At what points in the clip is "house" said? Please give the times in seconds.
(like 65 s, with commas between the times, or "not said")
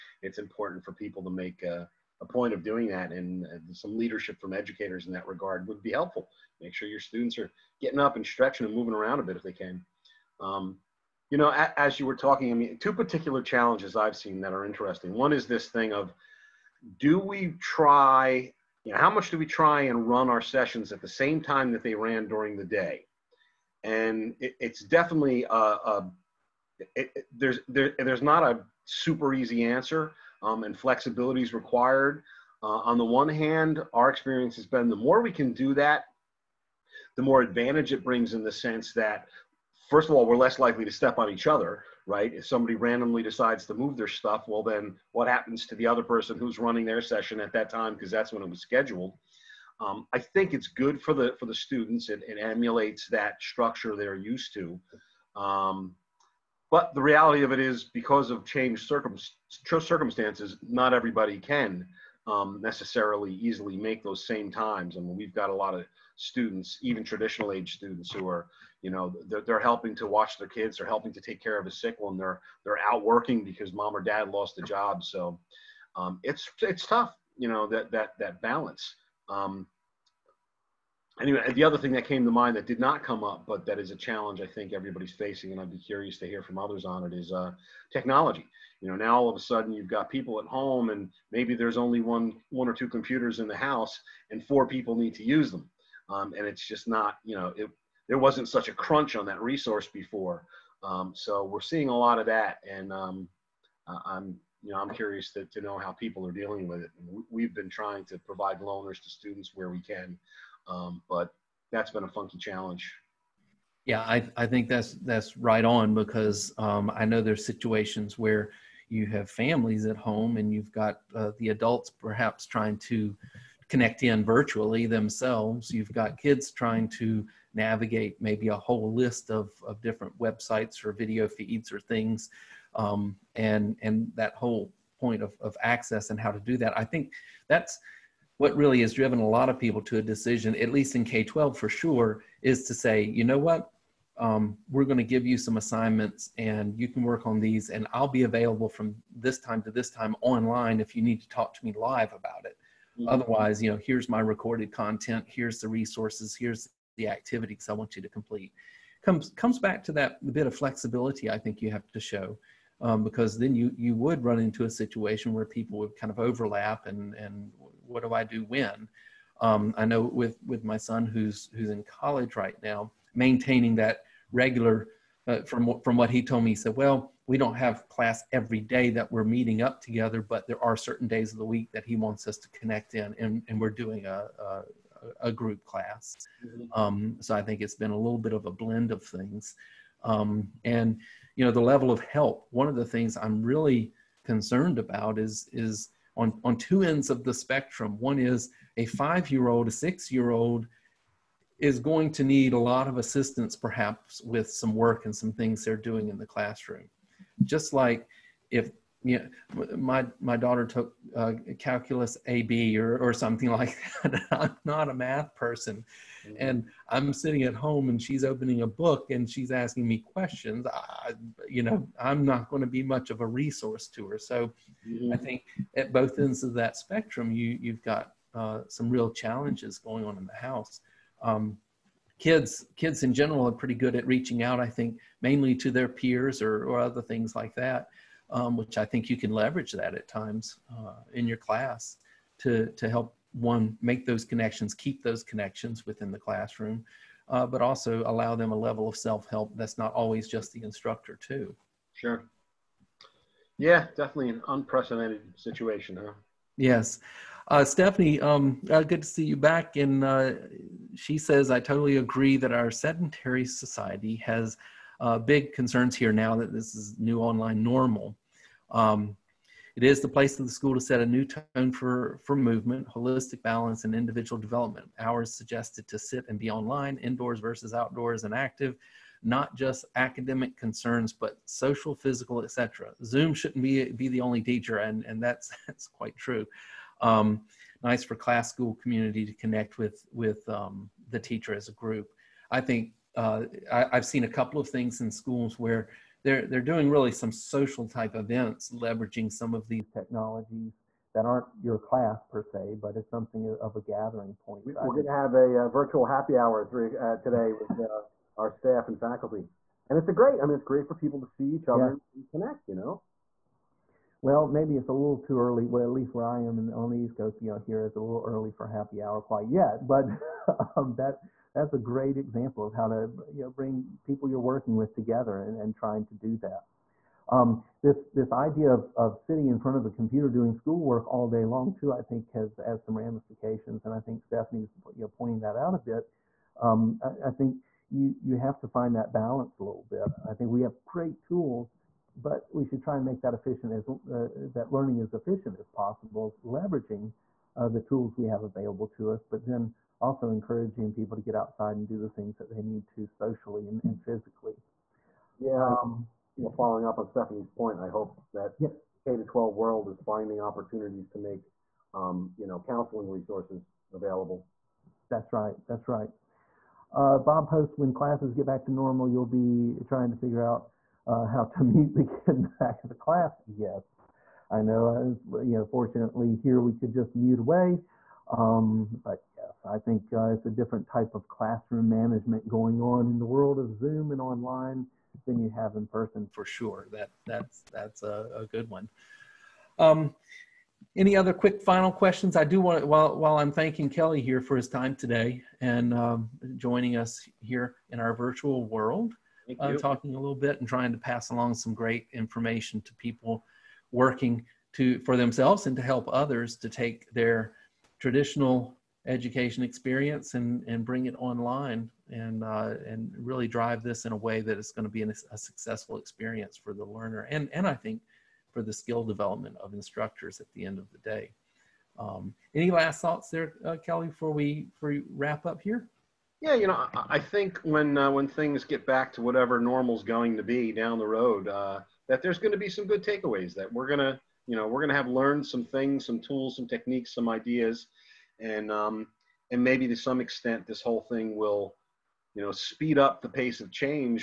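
93 s, 230 s.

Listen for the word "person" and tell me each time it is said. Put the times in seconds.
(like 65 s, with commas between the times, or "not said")
46 s, 215 s, 385 s.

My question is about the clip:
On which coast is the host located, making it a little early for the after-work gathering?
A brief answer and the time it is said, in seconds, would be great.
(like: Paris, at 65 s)
East Coast, at 316 s.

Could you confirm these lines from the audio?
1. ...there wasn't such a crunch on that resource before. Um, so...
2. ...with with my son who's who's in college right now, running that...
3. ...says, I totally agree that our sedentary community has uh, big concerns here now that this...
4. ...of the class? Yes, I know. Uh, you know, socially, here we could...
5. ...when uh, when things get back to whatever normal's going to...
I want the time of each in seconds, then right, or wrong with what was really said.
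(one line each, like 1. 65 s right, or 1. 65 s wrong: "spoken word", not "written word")
1. 98 s right
2. 170 s wrong: "maintaining", not "running"
3. 261 s wrong: "society", not "community"
4. 372 s wrong: "fortunately", not "socially"
5. 427 s right.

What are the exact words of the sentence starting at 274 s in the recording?
Hours suggested to sit and be online, indoors versus outdoors and active, not just academic concerns, but social, physical, etc.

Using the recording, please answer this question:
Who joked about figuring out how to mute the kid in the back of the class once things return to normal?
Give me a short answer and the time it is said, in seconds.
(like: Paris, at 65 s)
Bob, at 367 s.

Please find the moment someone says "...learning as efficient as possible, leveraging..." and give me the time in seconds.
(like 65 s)
344 s.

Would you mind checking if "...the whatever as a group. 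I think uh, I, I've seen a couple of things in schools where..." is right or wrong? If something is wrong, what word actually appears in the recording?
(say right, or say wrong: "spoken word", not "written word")
wrong: "teacher", not "whatever".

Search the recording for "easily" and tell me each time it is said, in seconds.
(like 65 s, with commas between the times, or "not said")
63 s.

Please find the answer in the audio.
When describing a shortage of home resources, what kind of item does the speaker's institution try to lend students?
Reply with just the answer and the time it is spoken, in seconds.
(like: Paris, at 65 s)
loaners, at 108 s.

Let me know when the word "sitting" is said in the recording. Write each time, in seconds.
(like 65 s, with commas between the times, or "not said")
217 s, 329 s.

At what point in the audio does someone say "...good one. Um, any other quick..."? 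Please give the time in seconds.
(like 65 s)
388 s.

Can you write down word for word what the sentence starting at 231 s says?
Um, kids kids in general are pretty good at reaching out.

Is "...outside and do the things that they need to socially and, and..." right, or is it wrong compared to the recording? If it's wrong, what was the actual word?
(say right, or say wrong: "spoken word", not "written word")
right.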